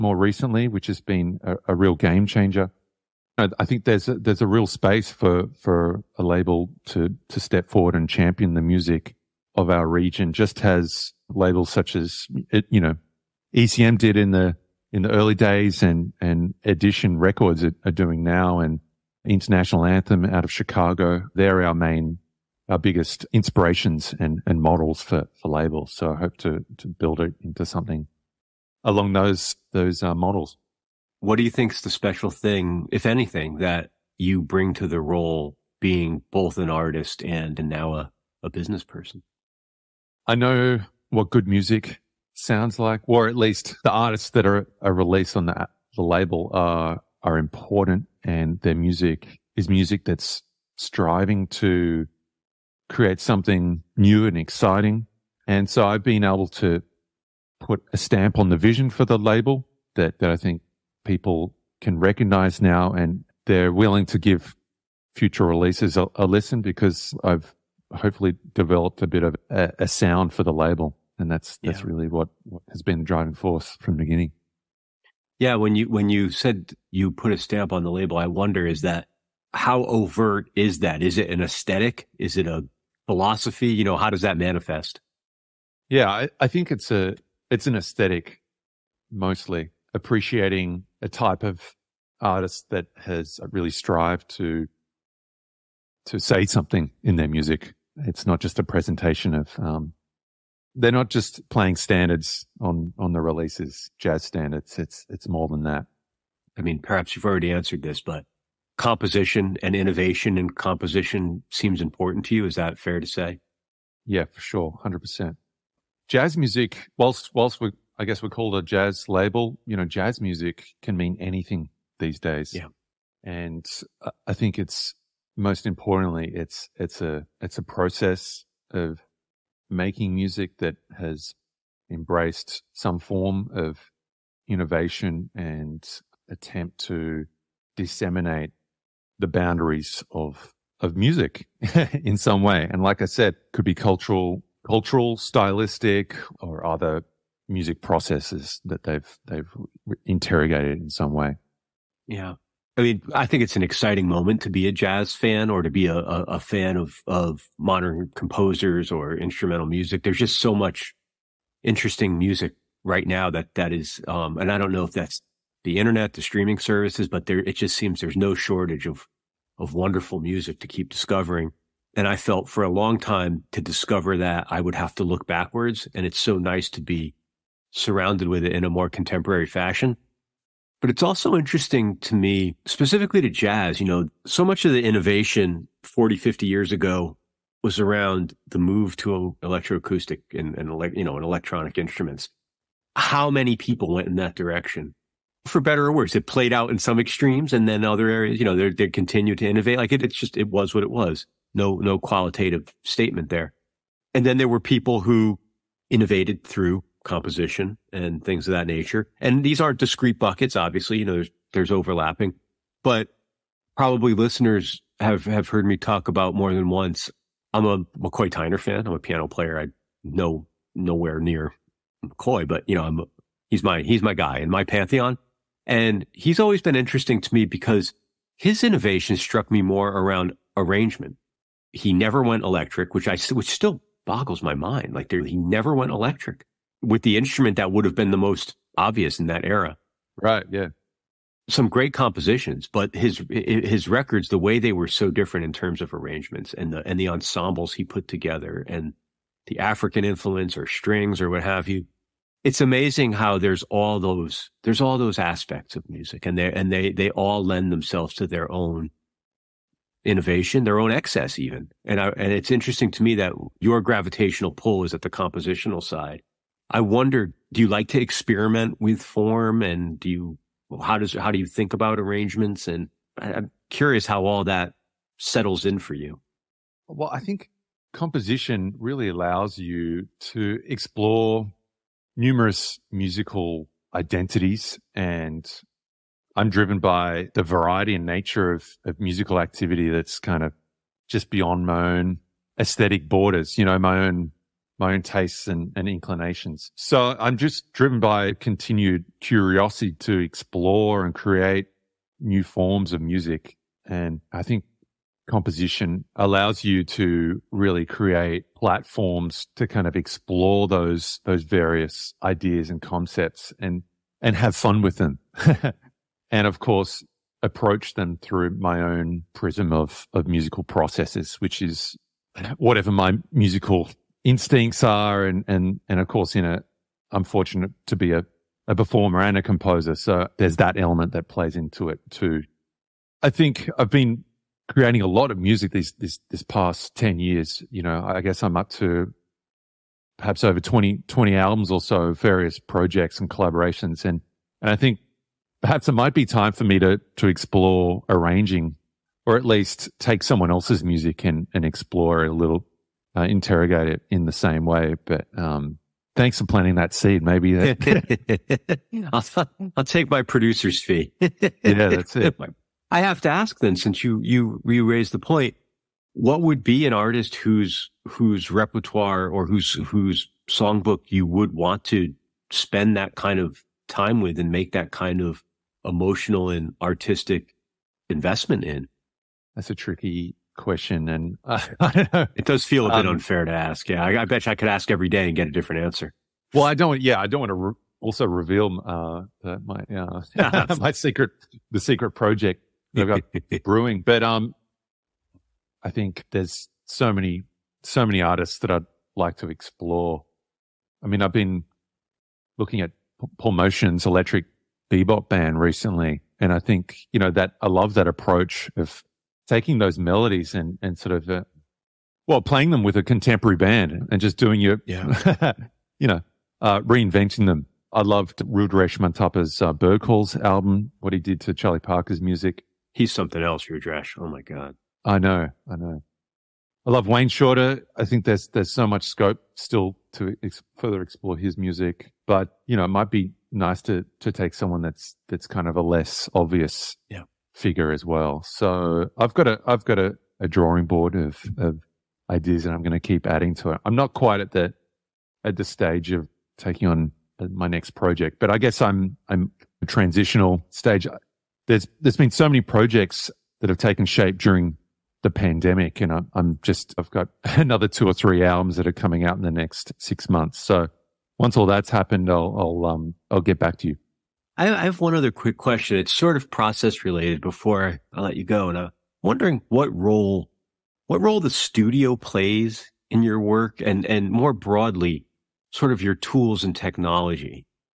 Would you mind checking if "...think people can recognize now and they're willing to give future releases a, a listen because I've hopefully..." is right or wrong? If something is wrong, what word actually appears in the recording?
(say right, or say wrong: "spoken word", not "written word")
right.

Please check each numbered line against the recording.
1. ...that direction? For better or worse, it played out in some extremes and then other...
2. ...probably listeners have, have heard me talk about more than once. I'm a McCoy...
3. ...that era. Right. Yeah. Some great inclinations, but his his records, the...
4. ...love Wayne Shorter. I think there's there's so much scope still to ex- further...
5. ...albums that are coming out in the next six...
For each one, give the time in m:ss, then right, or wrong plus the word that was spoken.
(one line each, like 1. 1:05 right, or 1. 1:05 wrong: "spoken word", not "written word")
1. 3:14 right
2. 3:33 right
3. 3:59 wrong: "compositions", not "inclinations"
4. 7:06 right
5. 7:38 right.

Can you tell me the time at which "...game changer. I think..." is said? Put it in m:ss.
0:01.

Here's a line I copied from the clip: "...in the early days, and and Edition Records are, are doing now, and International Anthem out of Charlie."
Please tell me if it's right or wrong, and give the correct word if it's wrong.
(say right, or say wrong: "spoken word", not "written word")
wrong: "Chicago", not "Charlie".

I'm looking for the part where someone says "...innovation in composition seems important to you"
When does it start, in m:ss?
1:49.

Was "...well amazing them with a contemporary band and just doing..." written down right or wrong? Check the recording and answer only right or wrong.
wrong.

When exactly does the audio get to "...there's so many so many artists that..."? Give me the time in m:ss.
6:36.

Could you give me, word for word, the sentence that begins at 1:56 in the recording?
Jazz music, whilst whilst we're I guess we call it a jazz label.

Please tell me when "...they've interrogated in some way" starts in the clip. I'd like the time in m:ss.
2:29.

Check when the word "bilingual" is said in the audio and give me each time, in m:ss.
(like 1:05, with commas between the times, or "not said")
not said.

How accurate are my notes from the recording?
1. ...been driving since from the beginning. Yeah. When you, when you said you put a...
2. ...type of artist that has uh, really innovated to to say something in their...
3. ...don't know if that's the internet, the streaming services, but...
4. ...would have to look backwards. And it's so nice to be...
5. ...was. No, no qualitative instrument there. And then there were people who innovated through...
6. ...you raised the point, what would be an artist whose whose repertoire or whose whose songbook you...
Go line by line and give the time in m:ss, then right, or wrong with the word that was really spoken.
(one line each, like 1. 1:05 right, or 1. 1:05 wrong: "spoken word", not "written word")
1. 1:12 wrong: "force", not "since"
2. 1:31 wrong: "strived", not "innovated"
3. 2:44 right
4. 2:54 right
5. 3:20 wrong: "statement", not "instrument"
6. 6:04 right.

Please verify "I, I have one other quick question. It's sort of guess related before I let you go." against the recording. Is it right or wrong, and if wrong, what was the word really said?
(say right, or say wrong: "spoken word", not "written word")
wrong: "process", not "guess".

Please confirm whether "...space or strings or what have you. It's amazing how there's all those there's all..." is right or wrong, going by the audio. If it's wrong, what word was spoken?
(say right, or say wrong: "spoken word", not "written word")
wrong: "influence", not "space".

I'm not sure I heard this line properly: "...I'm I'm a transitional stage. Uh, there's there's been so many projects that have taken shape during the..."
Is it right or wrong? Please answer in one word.
right.